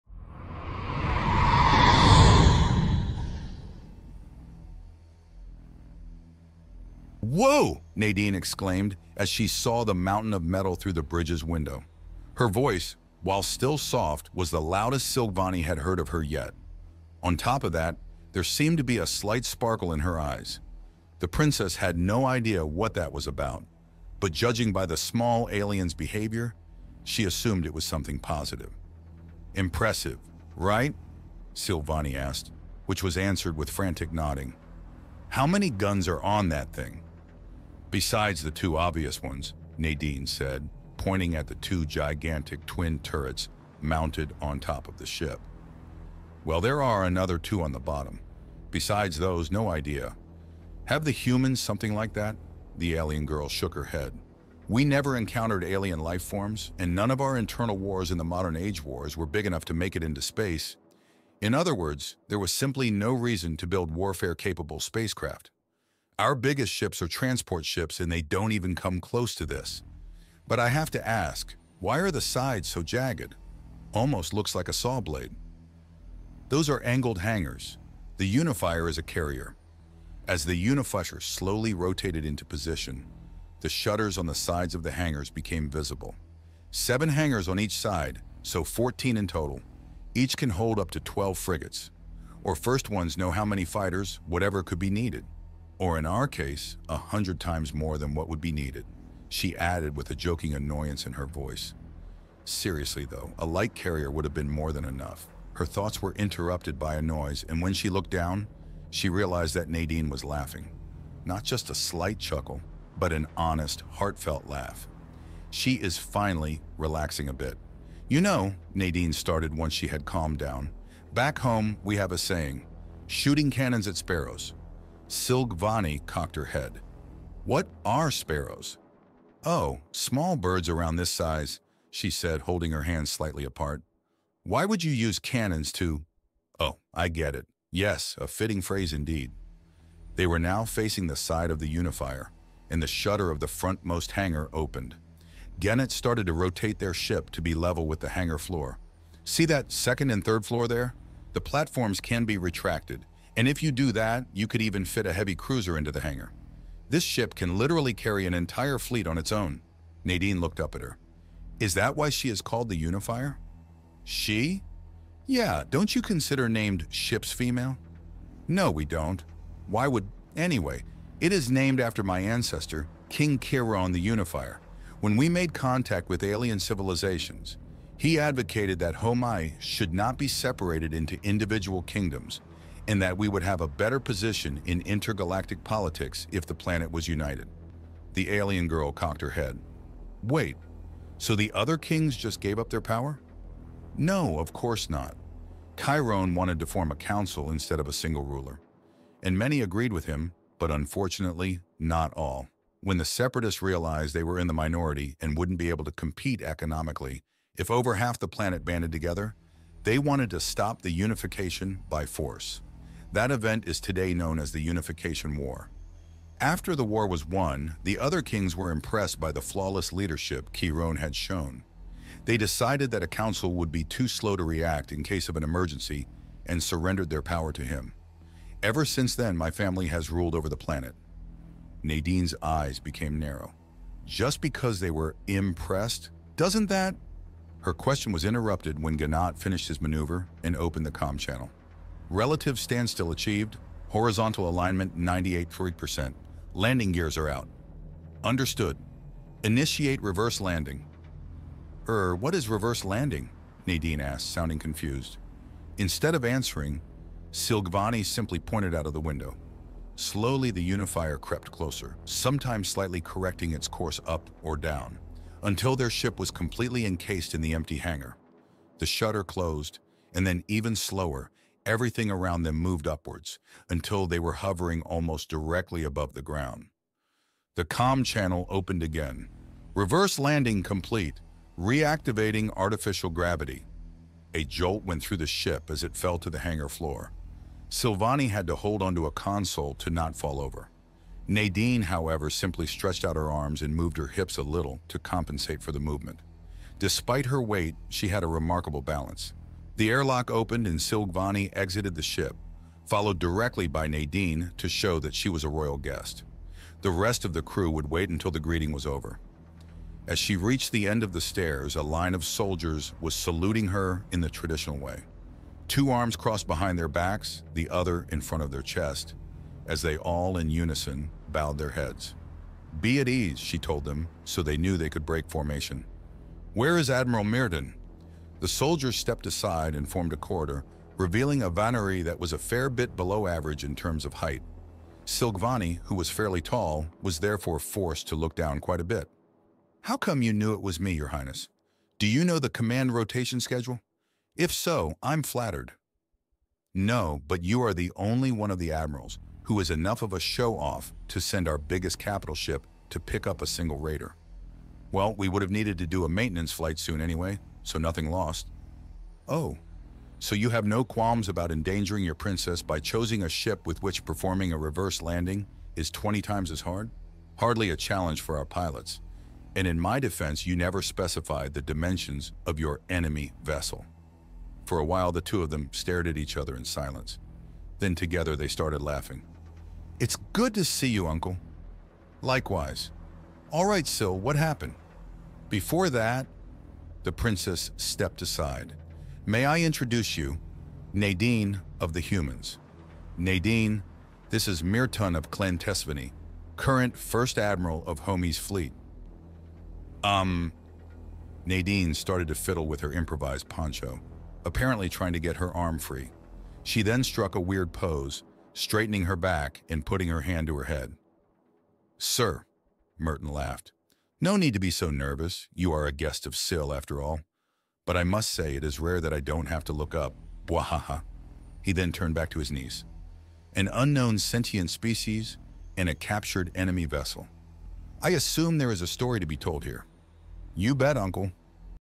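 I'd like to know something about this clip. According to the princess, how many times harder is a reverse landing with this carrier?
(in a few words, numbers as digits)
20.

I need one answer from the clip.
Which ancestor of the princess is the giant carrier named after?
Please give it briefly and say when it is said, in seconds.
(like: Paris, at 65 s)
King Chiron the Unifier, at 173 s.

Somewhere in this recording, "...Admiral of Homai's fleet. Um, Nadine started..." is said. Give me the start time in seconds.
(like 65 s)
397 s.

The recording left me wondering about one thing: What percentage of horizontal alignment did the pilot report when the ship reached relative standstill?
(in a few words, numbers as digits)
98.3%.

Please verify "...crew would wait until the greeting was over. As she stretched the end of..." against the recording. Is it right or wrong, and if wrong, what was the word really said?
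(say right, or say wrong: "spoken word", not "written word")
wrong: "reached", not "stretched".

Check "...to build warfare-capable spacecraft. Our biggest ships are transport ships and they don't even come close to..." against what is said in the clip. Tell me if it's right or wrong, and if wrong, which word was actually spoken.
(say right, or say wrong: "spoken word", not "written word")
right.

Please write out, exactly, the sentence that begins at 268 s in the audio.
The shutter closed, and then even slower, Everything around them moved upwards until they were hovering almost directly above the ground.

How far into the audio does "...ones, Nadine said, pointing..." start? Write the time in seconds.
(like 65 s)
39 s.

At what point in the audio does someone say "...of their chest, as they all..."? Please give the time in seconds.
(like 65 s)
318 s.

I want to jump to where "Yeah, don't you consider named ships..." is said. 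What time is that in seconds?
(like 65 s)
165 s.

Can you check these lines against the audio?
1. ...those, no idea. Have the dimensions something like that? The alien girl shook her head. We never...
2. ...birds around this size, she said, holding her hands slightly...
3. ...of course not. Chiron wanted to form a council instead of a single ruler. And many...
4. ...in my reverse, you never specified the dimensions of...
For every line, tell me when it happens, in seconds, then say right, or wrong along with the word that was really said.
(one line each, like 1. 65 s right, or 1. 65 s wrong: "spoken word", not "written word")
1. 49 s wrong: "humans", not "dimensions"
2. 130 s right
3. 194 s right
4. 369 s wrong: "defense", not "reverse".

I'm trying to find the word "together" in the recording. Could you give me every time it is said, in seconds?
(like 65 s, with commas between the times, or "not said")
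208 s, 377 s.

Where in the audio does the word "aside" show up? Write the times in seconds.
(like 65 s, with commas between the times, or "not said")
329 s, 388 s.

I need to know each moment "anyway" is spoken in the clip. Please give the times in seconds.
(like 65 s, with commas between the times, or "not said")
170 s, 357 s.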